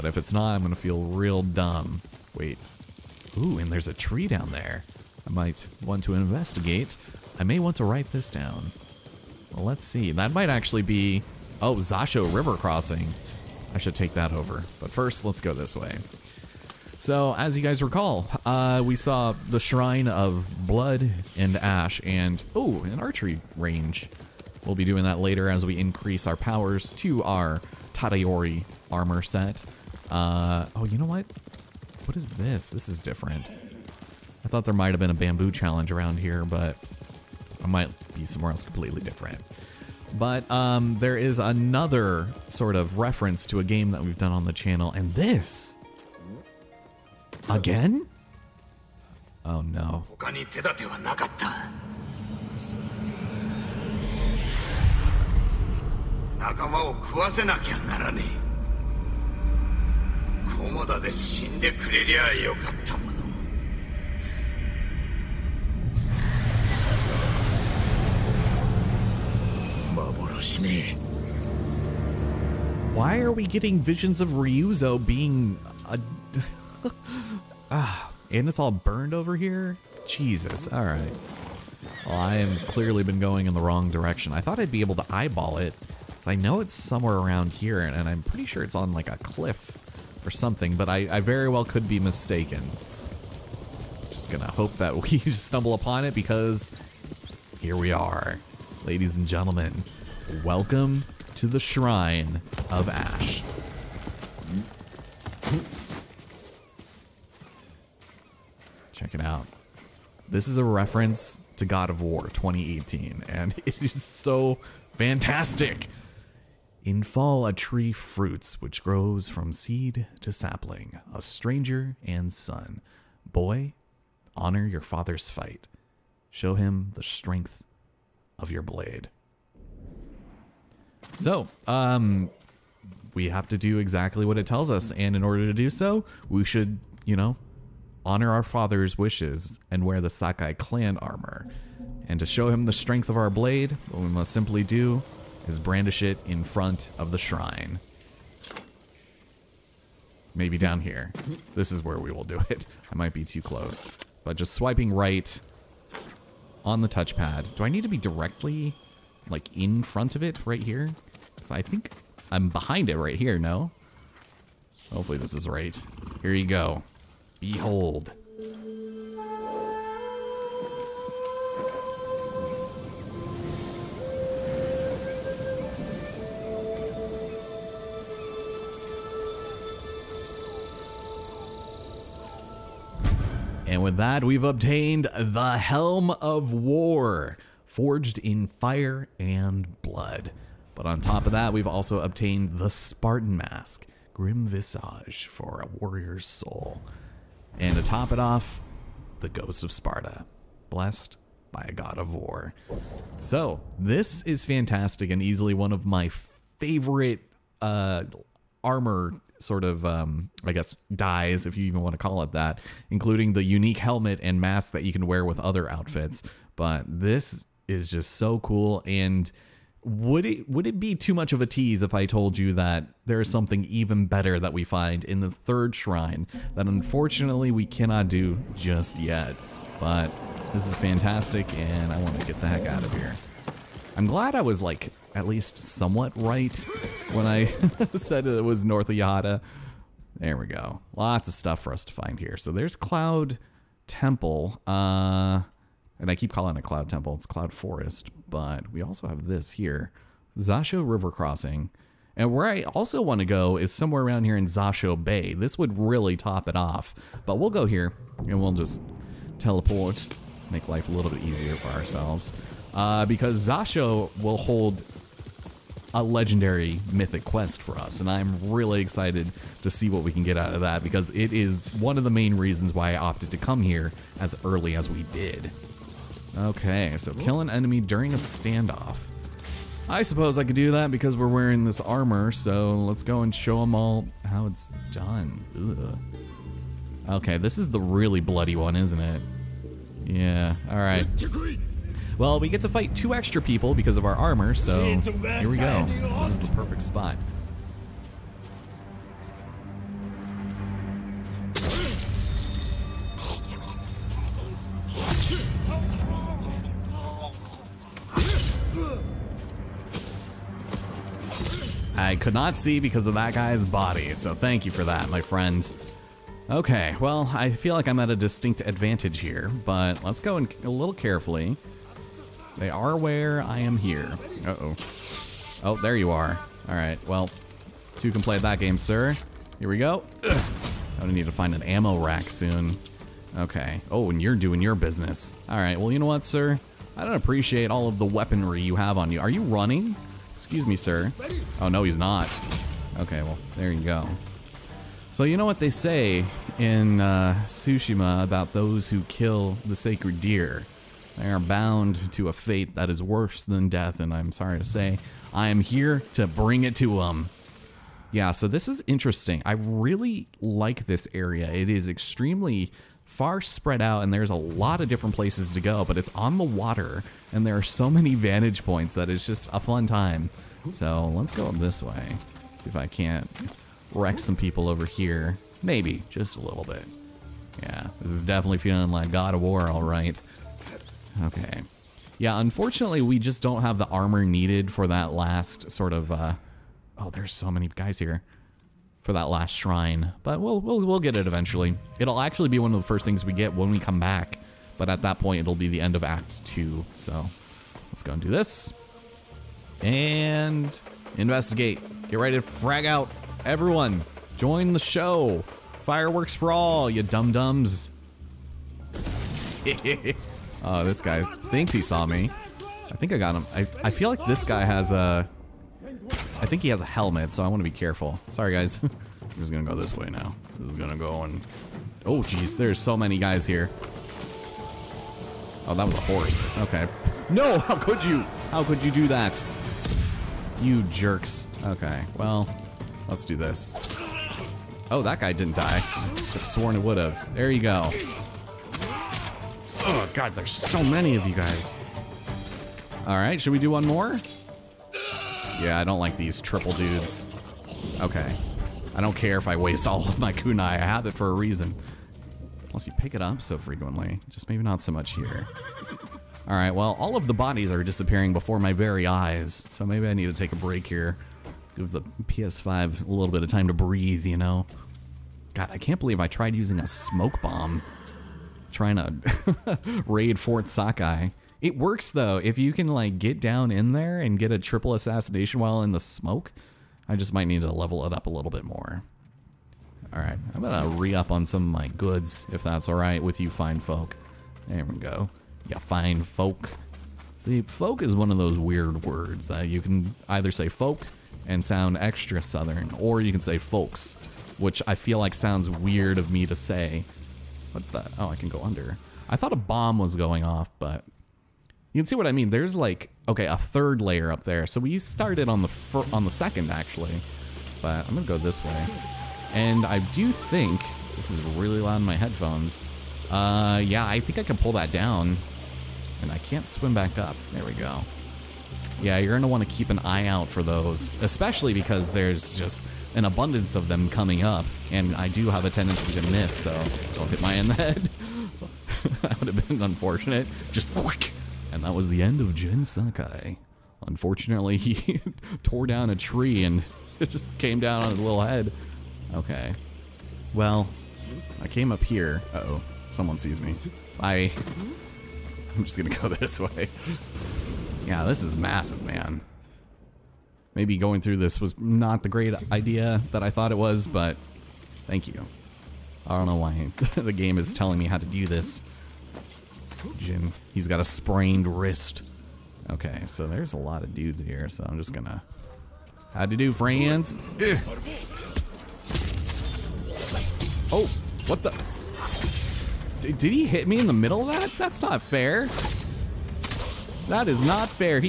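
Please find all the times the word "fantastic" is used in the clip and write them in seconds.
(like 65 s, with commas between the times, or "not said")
114 s, 204 s, 230 s.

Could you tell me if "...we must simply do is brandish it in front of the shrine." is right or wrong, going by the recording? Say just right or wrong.
right.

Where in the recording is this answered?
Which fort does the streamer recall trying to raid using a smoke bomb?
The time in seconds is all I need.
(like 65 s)
470 s.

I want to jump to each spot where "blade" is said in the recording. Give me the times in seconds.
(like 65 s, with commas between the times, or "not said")
128 s, 143 s.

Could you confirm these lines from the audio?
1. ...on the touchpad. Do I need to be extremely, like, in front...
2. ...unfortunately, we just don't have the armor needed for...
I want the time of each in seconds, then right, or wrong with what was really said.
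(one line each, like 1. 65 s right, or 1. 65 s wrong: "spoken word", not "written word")
1. 156 s wrong: "directly", not "extremely"
2. 382 s right.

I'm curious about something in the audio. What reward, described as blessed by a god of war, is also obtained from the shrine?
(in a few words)
Ghost of Sparta.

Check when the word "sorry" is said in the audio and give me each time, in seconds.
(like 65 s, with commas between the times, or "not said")
354 s, 418 s.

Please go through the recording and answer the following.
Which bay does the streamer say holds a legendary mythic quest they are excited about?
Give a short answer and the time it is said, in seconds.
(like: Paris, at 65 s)
Zasho Bay, at 254 s.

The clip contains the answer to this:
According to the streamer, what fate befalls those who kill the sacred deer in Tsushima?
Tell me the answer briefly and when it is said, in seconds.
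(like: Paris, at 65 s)
worse than death, at 353 s.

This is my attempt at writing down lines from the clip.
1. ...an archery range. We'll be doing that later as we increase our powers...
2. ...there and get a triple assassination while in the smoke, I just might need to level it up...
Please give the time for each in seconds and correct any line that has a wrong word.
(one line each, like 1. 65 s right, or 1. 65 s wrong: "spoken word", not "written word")
1. 22 s right
2. 473 s right.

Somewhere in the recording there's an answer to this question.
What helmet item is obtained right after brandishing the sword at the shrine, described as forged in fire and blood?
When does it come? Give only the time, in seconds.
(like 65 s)
185 s.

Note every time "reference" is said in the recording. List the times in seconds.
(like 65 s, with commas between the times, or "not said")
42 s, 110 s.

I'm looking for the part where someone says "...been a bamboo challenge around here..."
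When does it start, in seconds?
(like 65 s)
34 s.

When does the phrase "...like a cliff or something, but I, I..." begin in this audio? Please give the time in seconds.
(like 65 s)
88 s.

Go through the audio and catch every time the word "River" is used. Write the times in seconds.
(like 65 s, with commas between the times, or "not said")
12 s, 250 s.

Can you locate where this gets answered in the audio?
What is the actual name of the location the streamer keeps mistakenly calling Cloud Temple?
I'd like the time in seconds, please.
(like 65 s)
247 s.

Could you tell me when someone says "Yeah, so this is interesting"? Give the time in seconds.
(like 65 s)
358 s.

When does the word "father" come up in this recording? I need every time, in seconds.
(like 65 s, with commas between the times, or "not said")
124 s, 138 s.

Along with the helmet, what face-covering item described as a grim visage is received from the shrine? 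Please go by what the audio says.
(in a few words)
Spartan Mask.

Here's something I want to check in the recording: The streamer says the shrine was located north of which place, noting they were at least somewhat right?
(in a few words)
Yahada.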